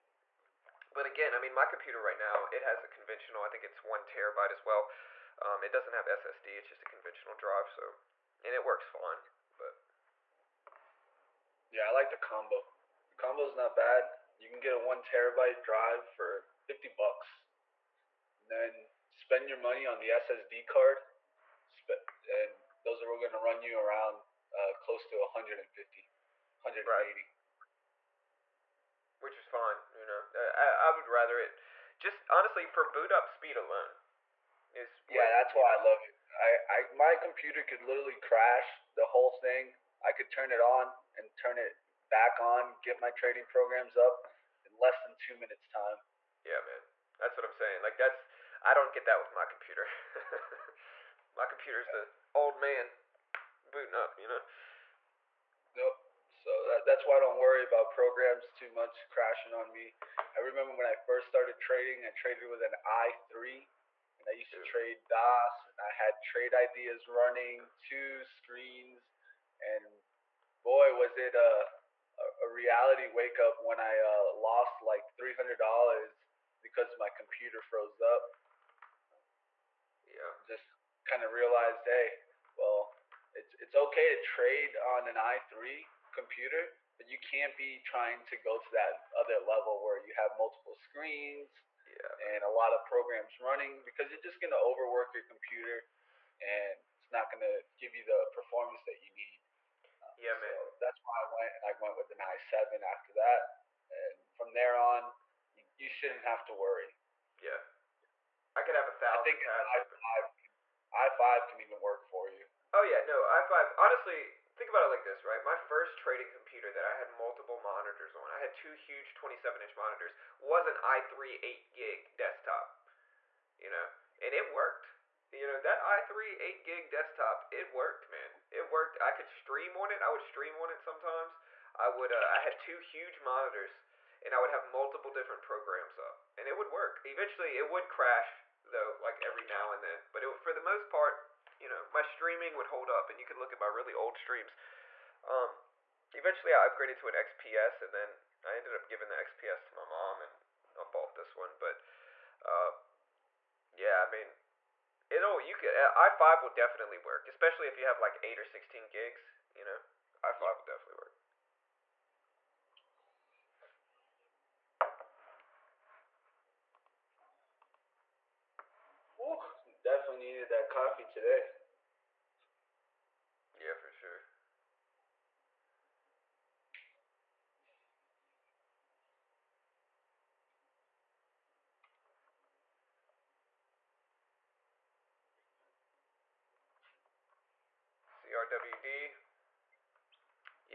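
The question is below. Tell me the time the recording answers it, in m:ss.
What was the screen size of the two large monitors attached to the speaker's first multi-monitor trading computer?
1:59.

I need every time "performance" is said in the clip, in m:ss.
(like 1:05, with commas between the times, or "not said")
1:38.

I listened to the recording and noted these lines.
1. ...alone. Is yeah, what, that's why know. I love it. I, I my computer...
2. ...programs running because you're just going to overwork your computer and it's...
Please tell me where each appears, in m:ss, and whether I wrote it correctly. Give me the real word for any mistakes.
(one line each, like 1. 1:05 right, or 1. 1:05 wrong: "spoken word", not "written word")
1. 0:33 right
2. 1:32 right.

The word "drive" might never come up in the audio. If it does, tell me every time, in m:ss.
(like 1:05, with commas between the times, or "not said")
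0:07, 0:15.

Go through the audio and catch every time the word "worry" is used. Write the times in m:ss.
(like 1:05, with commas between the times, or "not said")
0:57, 1:46.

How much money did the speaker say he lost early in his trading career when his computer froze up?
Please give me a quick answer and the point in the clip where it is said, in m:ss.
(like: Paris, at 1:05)
$300, at 1:15.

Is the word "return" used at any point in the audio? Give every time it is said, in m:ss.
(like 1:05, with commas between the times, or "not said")
not said.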